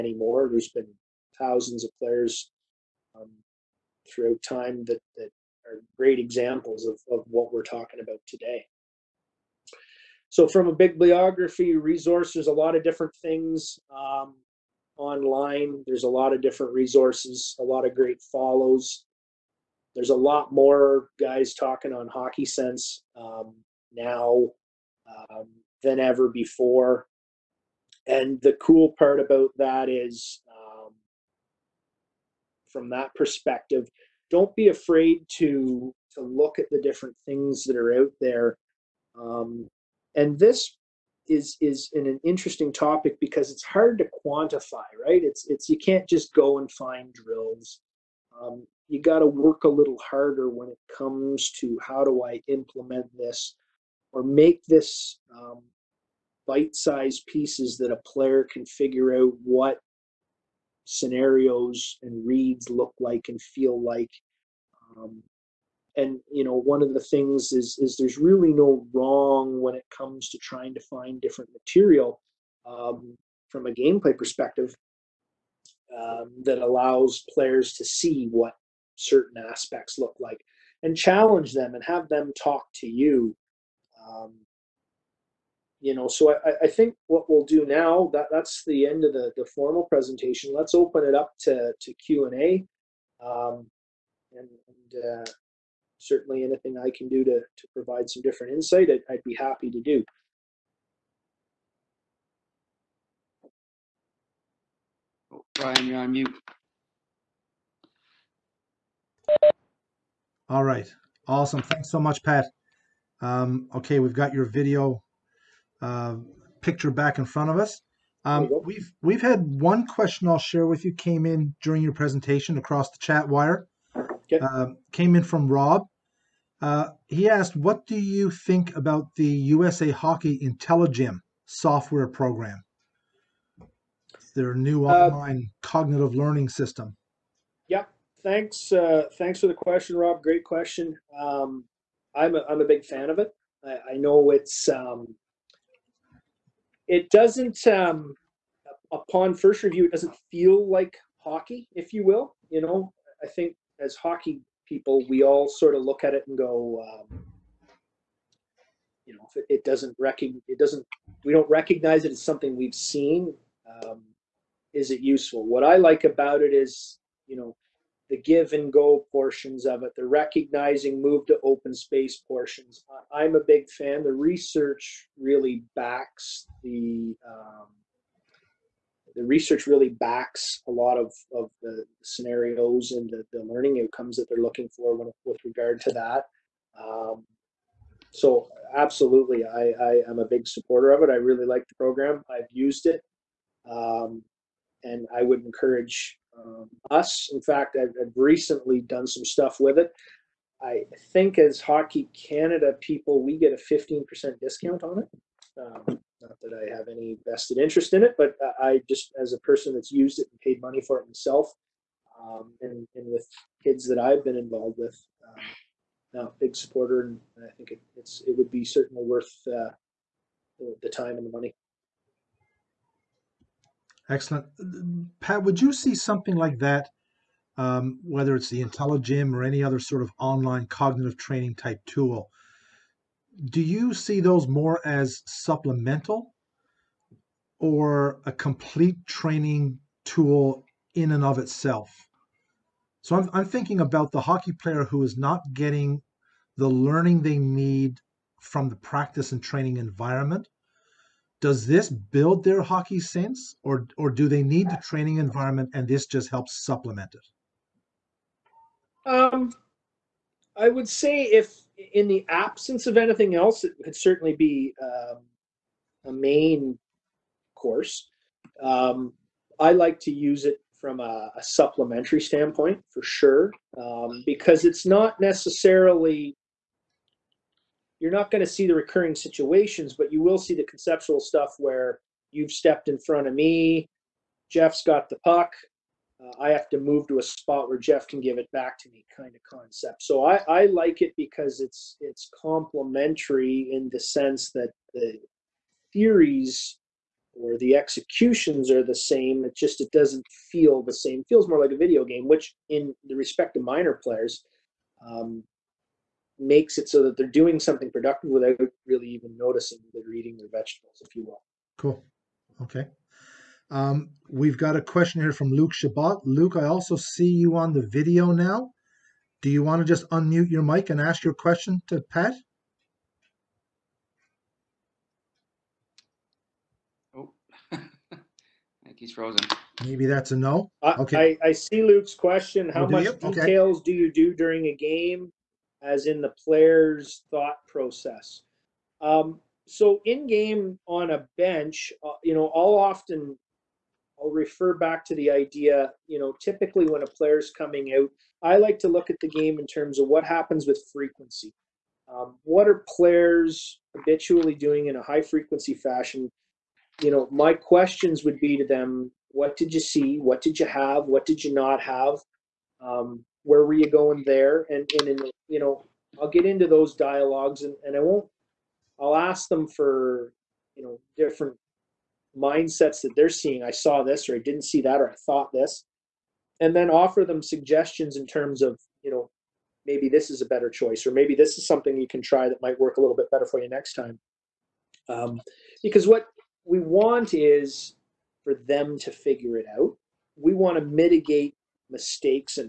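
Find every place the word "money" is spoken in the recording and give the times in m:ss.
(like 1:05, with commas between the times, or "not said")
3:30, 3:41.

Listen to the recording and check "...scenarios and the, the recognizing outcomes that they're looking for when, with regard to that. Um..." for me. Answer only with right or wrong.
wrong.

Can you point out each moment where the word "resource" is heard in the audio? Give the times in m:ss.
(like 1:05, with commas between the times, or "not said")
0:11, 0:16.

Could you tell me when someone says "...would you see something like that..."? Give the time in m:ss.
3:45.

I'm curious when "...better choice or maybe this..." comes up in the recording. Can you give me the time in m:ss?
6:20.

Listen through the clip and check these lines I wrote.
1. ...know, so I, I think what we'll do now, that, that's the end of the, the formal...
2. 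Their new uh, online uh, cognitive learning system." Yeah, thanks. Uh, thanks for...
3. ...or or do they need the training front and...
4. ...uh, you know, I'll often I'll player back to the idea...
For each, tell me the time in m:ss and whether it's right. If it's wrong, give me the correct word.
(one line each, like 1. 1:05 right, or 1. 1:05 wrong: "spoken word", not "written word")
1. 1:25 right
2. 2:14 right
3. 4:13 wrong: "environment", not "front"
4. 5:42 wrong: "refer", not "player".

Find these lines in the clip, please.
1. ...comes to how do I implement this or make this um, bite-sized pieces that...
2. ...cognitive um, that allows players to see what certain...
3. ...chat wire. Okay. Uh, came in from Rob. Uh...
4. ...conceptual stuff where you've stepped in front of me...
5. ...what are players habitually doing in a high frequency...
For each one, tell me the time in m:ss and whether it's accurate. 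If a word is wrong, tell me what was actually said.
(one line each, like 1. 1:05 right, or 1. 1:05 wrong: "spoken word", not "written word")
1. 0:50 right
2. 1:14 wrong: "perspective", not "cognitive"
3. 2:02 right
4. 4:40 right
5. 5:52 right.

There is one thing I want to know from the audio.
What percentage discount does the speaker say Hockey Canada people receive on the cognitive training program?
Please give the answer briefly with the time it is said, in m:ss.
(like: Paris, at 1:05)
15%, at 3:23.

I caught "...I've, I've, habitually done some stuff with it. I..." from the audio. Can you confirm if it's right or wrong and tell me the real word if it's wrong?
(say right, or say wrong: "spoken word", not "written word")
wrong: "recently", not "habitually".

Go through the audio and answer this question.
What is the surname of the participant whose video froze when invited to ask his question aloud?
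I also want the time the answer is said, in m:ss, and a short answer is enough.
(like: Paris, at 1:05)
Shabbat, at 5:15.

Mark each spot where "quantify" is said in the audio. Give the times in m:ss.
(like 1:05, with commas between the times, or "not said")
0:44.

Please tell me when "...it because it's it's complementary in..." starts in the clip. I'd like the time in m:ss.
4:51.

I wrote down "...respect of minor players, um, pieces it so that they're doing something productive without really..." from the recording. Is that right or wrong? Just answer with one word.
wrong.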